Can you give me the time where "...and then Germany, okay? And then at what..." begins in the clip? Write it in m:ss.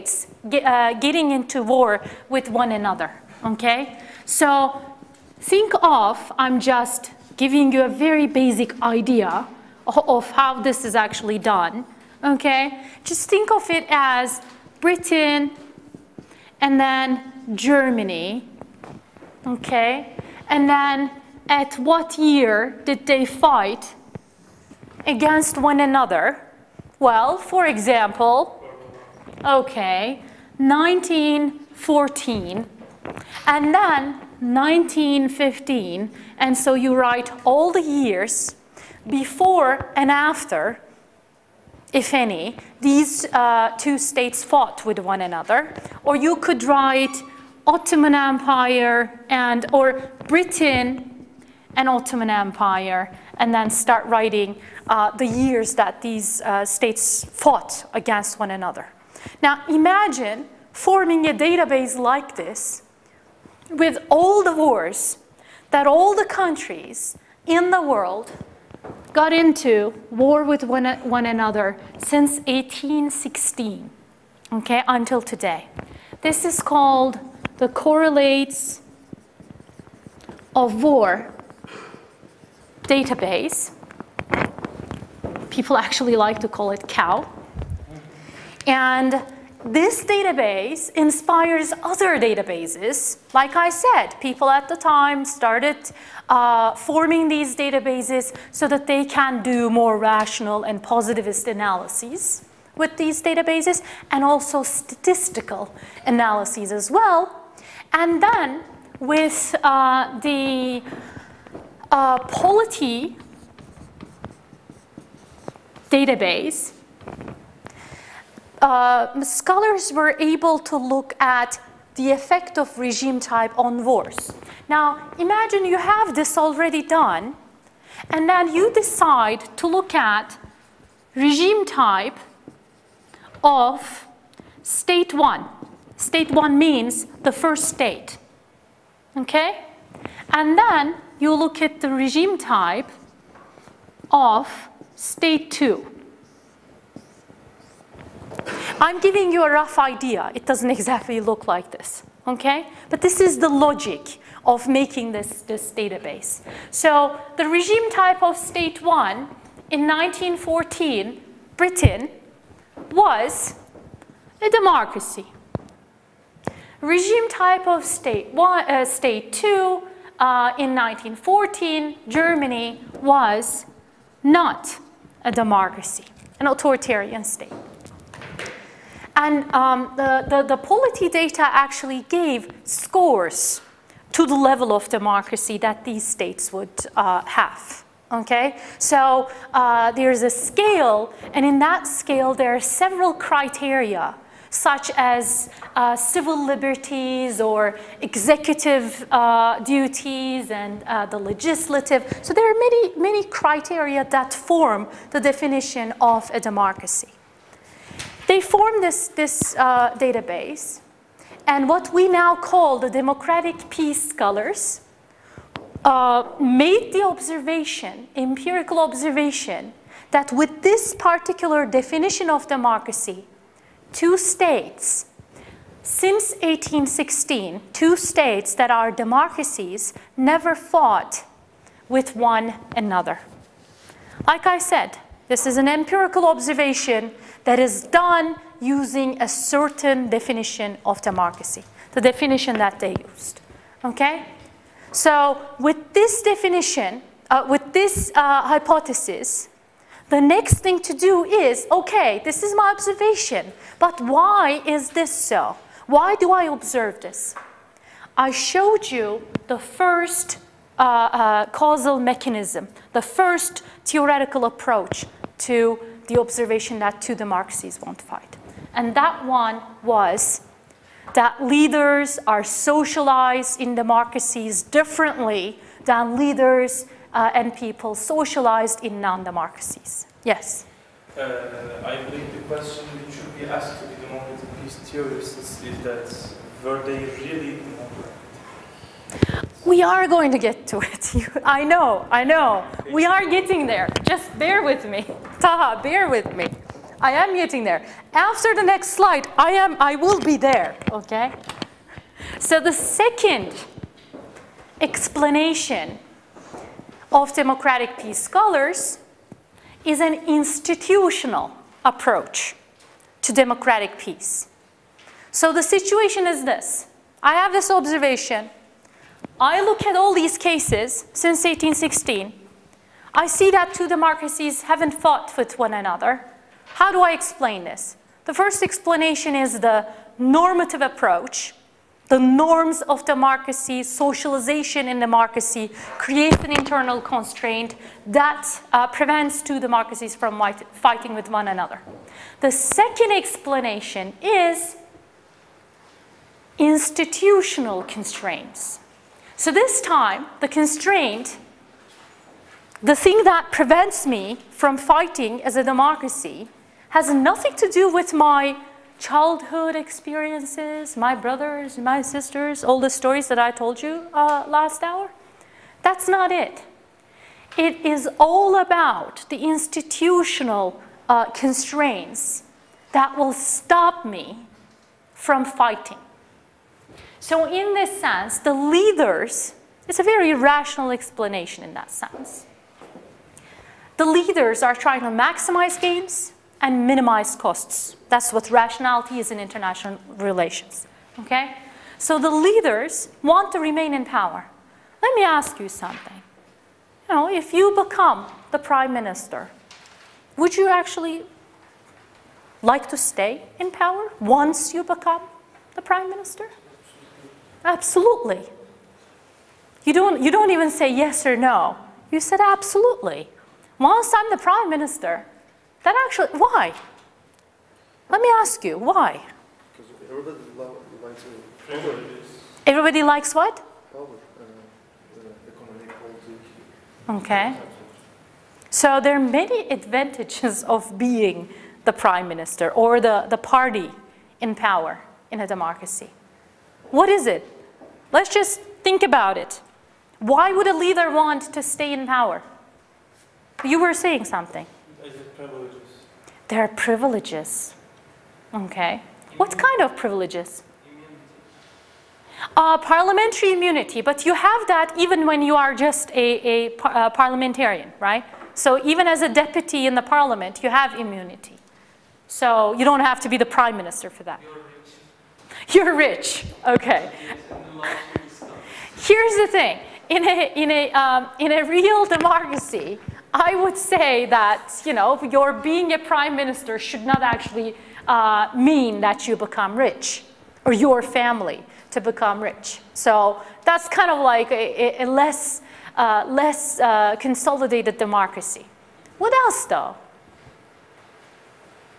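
0:16.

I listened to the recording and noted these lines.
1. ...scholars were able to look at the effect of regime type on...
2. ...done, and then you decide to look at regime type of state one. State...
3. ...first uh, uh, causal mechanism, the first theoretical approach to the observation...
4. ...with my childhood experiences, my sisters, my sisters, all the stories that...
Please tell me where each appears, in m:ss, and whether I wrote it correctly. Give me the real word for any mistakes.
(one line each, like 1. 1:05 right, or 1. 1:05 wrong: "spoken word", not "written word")
1. 1:59 right
2. 2:06 right
3. 4:19 right
4. 5:57 wrong: "brothers", not "sisters".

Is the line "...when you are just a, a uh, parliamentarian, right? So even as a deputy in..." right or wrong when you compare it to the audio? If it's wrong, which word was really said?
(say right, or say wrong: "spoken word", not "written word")
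right.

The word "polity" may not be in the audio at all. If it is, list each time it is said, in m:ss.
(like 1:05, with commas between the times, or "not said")
1:52, 3:00.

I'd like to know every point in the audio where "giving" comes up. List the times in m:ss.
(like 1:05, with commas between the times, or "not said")
0:07, 2:28.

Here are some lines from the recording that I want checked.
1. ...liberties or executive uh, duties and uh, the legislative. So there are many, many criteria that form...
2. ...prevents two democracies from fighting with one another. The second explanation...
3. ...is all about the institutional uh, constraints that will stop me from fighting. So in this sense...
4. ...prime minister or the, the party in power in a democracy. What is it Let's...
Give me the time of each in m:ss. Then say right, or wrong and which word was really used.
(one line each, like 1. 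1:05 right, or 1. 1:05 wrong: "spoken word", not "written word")
1. 3:16 right
2. 5:38 right
3. 6:07 right
4. 7:11 right.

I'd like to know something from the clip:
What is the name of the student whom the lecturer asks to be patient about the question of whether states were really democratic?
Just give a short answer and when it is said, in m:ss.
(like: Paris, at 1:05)
Taha, at 4:55.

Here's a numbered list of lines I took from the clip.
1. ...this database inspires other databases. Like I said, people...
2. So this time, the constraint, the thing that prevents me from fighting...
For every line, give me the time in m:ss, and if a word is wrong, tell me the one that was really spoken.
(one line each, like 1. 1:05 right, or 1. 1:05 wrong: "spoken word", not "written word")
1. 1:29 right
2. 5:49 right.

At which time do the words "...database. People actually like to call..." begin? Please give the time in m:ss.
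1:22.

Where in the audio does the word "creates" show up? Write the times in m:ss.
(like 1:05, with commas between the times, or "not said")
5:35.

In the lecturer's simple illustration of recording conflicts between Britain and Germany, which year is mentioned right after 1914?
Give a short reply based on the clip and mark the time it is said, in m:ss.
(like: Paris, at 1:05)
1915, at 0:34.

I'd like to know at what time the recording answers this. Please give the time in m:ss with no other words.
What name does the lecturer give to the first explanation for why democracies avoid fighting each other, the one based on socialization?
5:30.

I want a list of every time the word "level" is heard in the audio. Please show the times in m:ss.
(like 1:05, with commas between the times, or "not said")
3:04.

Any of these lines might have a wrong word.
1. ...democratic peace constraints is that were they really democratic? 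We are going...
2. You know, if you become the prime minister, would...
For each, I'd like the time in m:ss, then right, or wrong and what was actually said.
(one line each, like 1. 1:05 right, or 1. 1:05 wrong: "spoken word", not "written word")
1. 4:43 wrong: "theorists", not "constraints"
2. 6:37 right.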